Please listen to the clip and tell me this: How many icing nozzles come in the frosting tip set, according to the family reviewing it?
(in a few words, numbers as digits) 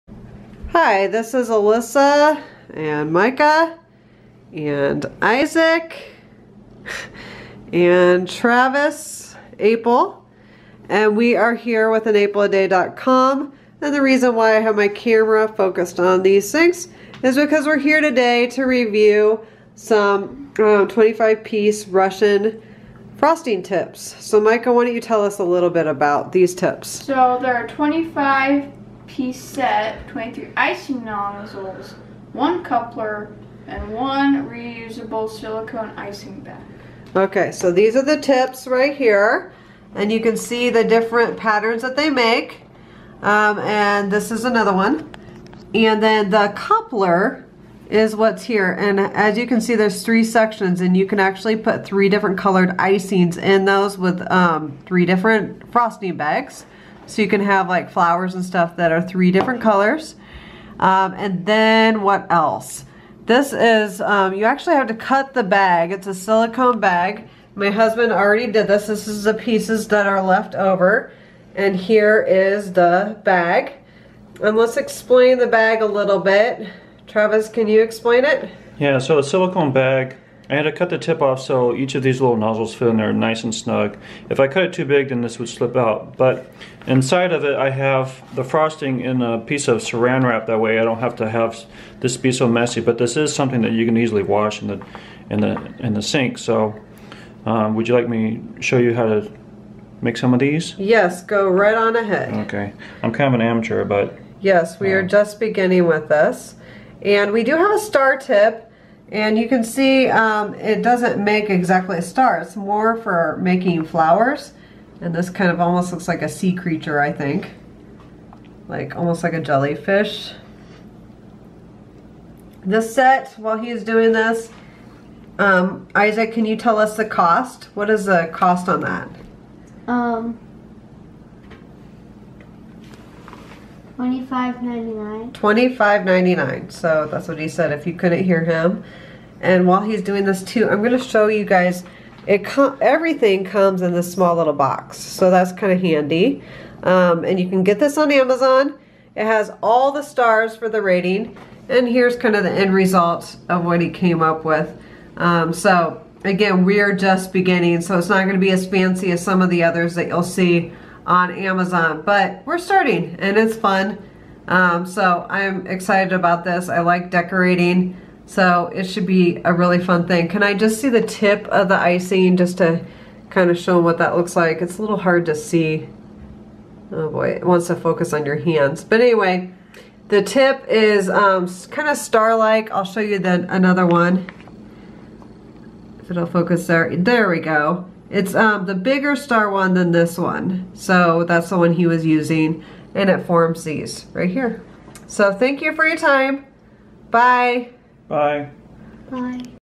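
23.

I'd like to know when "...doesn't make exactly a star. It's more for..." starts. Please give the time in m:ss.
1:50.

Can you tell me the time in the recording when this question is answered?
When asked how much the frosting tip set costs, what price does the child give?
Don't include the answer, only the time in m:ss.
2:14.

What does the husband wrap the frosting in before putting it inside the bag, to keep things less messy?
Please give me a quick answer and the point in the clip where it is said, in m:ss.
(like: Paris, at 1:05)
saran wrap, at 1:29.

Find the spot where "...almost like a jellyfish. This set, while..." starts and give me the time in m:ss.
1:58.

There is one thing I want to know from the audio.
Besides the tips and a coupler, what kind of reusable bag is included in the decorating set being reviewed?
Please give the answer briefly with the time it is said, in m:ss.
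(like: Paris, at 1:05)
silicone icing bag, at 0:34.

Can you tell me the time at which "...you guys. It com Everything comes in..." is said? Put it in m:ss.
2:21.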